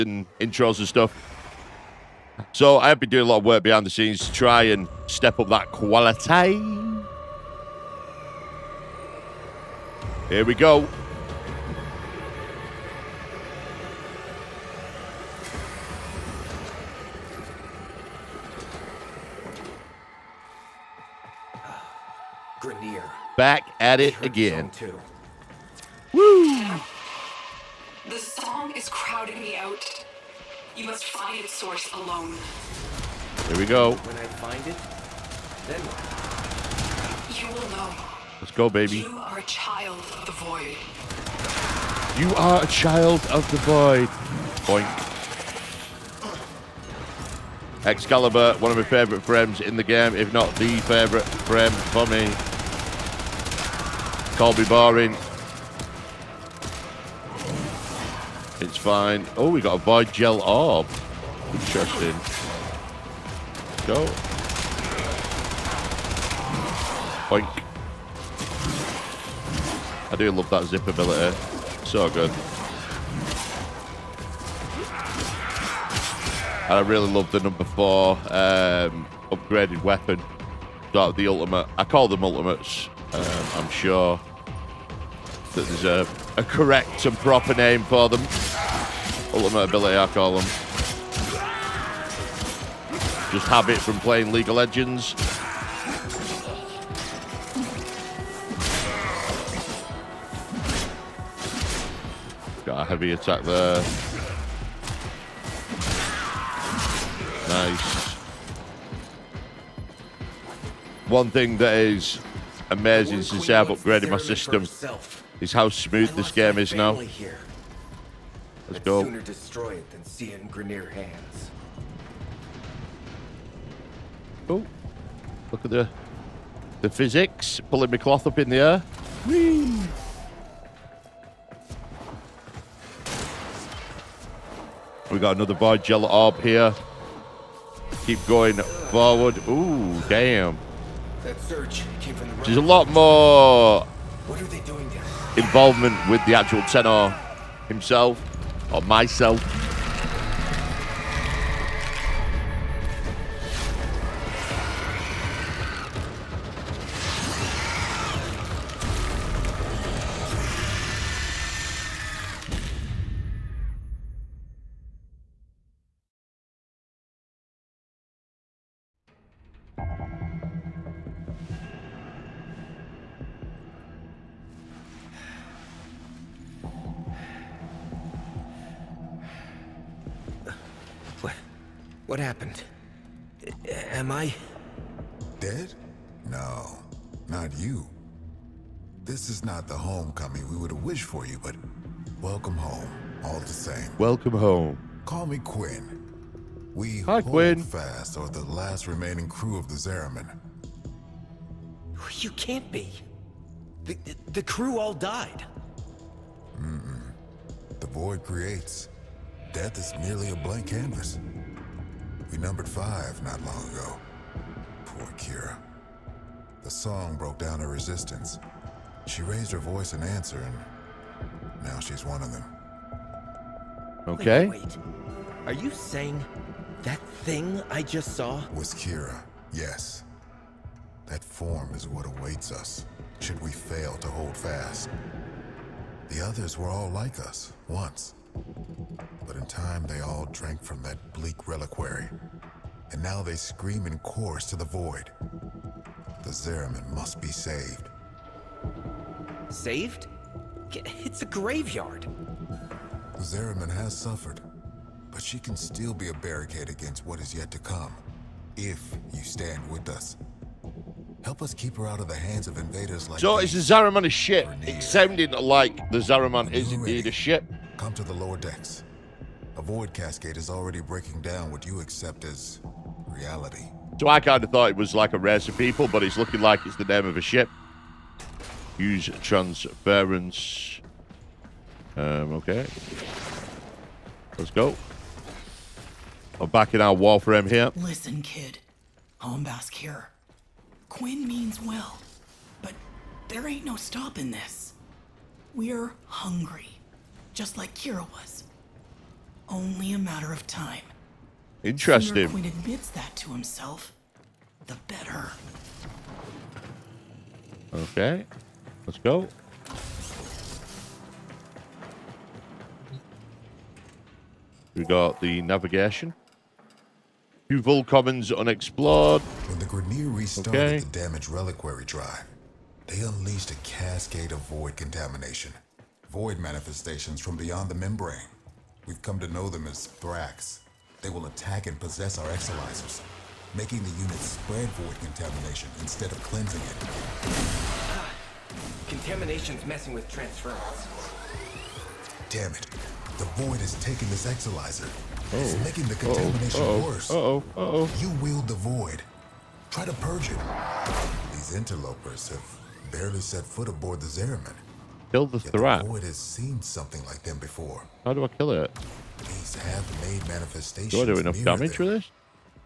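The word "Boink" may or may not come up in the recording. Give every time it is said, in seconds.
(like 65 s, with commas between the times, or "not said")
44 s, 67 s.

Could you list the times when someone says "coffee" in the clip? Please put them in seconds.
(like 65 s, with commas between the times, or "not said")
not said.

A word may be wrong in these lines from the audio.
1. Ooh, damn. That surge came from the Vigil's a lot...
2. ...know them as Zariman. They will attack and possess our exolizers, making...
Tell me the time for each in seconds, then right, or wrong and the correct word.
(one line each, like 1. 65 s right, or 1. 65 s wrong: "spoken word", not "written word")
1. 139 s wrong: "There", not "Vigil"
2. 329 s wrong: "Thrax", not "Zariman".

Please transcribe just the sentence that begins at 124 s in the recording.
Oh, look at the the physics pulling my cloth up in the air.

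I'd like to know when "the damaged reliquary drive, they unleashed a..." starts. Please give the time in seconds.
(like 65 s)
320 s.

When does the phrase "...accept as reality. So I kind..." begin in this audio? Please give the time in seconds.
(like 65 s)
271 s.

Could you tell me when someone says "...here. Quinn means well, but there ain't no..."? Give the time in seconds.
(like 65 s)
289 s.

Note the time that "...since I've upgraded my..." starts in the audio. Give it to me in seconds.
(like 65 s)
113 s.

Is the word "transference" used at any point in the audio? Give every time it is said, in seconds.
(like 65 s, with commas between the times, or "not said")
279 s, 340 s.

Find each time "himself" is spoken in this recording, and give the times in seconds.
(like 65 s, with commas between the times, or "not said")
147 s, 303 s.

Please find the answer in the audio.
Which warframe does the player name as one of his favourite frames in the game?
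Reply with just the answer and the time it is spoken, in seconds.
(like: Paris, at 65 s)
Excalibur, at 47 s.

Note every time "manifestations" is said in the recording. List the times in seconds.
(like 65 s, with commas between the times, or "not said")
326 s, 360 s.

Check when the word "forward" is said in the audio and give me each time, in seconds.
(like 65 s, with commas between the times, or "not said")
138 s.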